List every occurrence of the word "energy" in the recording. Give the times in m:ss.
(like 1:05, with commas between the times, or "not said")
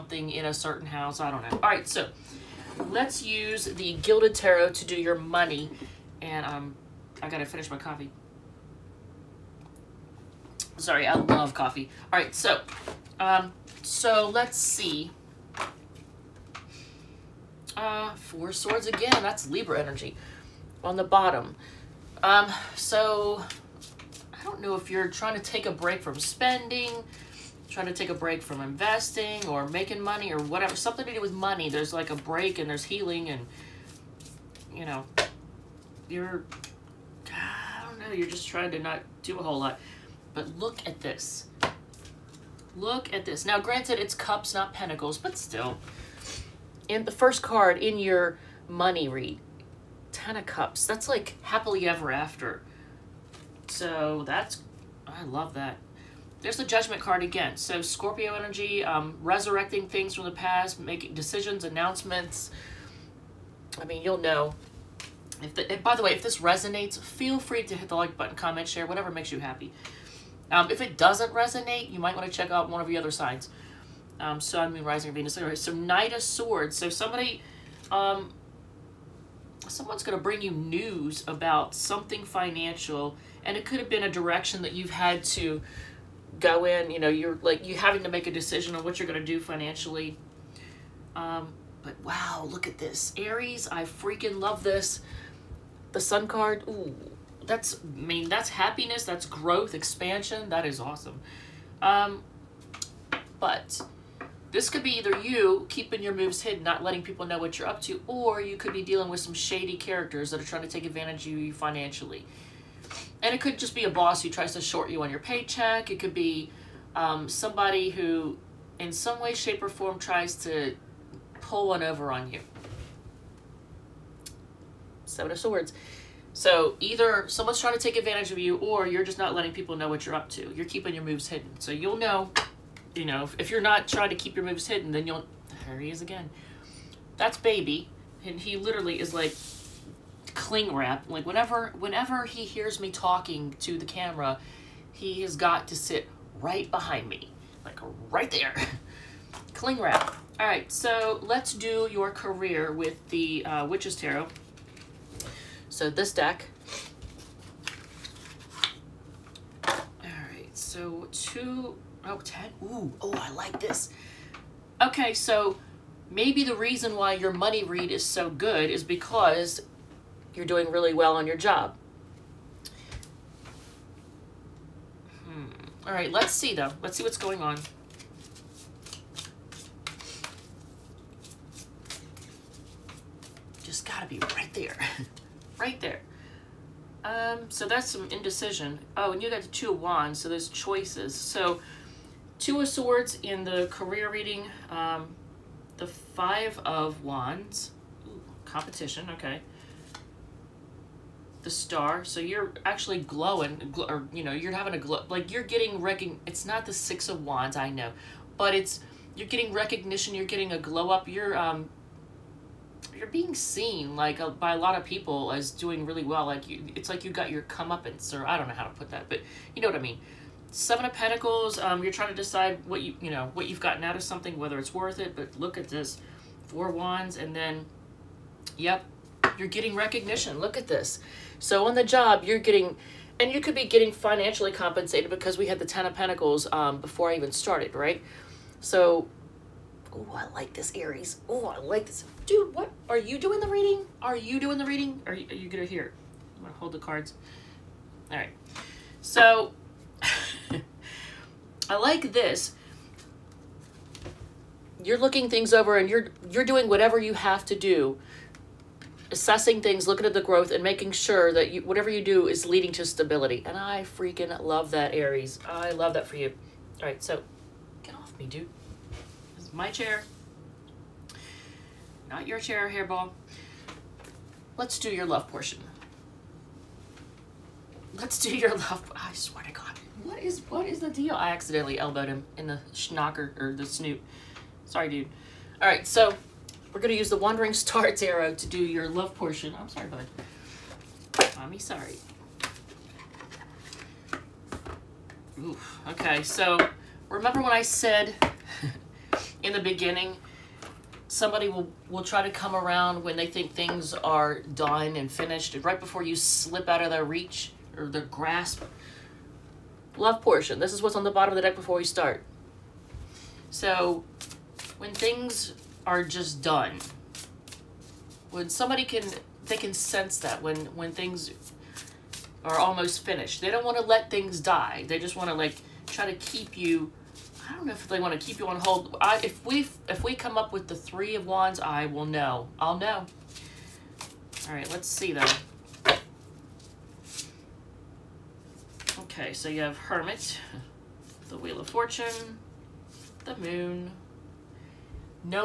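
0:19, 0:58.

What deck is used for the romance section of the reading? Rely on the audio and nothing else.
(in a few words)
Wandering Star Tarot.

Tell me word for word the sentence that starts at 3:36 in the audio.
Like you, it's like you got your comeuppance, or I don't know how to put that, but you know what I mean.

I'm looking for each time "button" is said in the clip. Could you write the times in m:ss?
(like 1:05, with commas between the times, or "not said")
1:08.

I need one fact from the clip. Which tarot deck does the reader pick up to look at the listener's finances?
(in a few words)
Gilded Tarot.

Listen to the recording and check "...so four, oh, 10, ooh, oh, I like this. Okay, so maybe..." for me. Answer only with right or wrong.
wrong.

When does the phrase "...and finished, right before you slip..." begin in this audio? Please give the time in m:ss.
5:04.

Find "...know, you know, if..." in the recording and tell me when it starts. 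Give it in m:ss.
2:11.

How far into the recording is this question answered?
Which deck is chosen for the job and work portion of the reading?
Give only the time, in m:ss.
2:33.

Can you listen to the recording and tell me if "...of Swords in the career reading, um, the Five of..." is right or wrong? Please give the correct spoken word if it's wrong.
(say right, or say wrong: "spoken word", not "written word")
right.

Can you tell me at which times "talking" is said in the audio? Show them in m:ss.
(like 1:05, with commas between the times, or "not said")
2:22.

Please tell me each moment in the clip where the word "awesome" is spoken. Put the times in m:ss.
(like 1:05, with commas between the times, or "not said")
1:40.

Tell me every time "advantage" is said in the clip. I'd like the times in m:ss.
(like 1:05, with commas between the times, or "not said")
1:50, 2:07.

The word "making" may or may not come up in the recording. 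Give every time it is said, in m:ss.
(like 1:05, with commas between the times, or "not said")
0:29, 1:00, 4:20.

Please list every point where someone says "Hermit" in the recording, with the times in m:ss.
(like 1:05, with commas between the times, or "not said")
5:39.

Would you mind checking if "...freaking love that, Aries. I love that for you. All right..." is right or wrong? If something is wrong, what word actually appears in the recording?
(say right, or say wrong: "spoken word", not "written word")
right.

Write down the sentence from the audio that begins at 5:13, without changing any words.
So, when things are just done, when somebody can, they can sense that when when things are almost finished.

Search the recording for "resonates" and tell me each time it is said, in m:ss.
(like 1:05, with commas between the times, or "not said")
1:06, 1:11.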